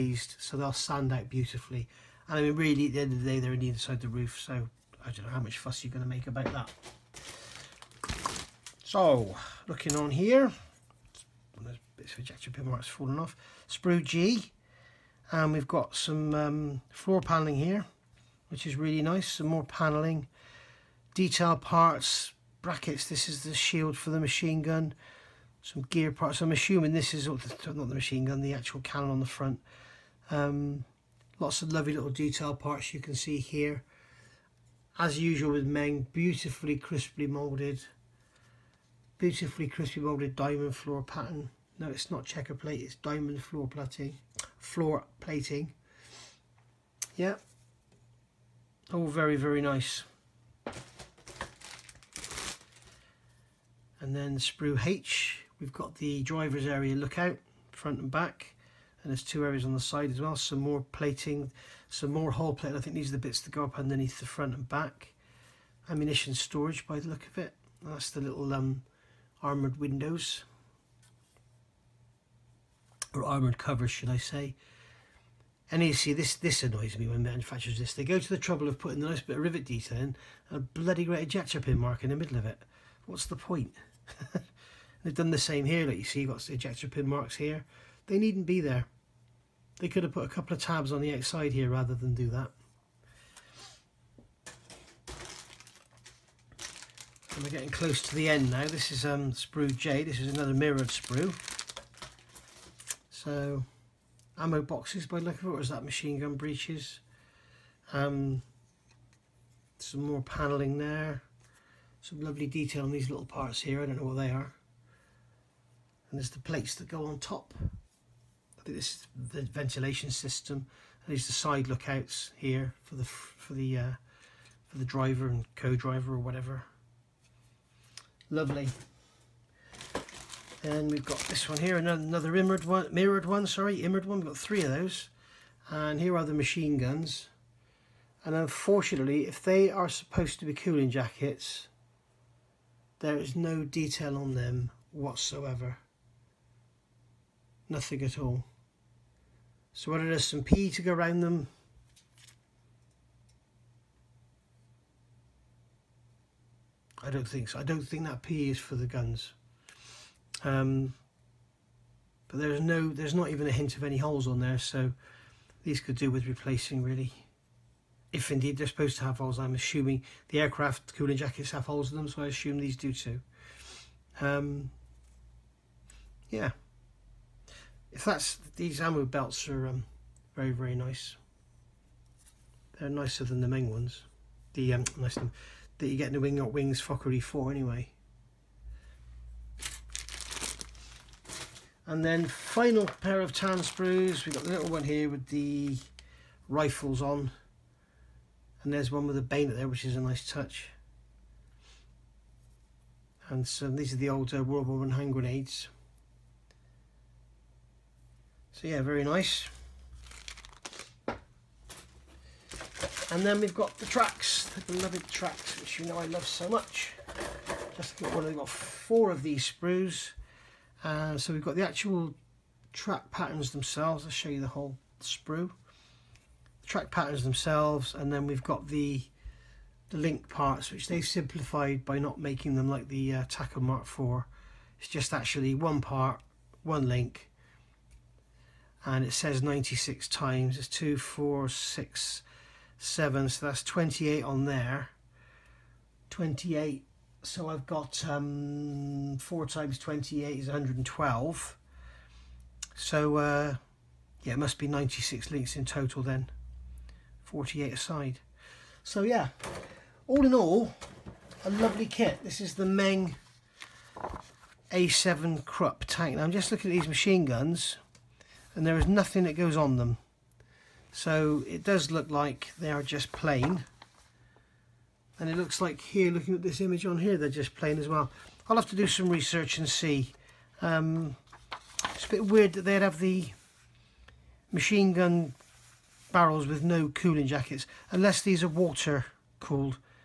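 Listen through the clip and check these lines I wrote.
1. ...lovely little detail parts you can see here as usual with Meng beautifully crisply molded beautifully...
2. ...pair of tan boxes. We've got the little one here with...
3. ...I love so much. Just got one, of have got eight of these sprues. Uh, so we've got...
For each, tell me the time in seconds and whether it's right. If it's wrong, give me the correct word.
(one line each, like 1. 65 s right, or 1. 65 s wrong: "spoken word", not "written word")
1. 31 s right
2. 193 s wrong: "sprues", not "boxes"
3. 215 s wrong: "four", not "eight".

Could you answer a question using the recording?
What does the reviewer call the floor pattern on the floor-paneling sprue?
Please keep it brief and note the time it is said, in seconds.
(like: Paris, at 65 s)
Diamond floor plating, at 42 s.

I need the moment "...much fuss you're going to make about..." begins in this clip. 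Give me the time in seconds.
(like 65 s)
5 s.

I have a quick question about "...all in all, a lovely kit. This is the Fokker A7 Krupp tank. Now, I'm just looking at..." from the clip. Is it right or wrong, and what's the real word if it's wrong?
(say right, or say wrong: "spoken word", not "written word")
wrong: "Meng", not "Fokker".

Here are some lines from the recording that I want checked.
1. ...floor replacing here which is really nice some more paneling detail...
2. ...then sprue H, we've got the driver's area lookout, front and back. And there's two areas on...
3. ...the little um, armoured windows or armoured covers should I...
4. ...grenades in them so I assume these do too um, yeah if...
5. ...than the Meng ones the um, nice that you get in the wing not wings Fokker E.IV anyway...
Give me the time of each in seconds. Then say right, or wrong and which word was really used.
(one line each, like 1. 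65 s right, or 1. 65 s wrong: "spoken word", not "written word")
1. 16 s wrong: "paneling", not "replacing"
2. 54 s right
3. 68 s right
4. 171 s wrong: "holes", not "grenades"
5. 183 s right.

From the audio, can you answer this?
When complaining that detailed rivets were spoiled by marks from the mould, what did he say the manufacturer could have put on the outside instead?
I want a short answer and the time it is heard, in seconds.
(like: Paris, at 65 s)
A couple of tabs, at 90 s.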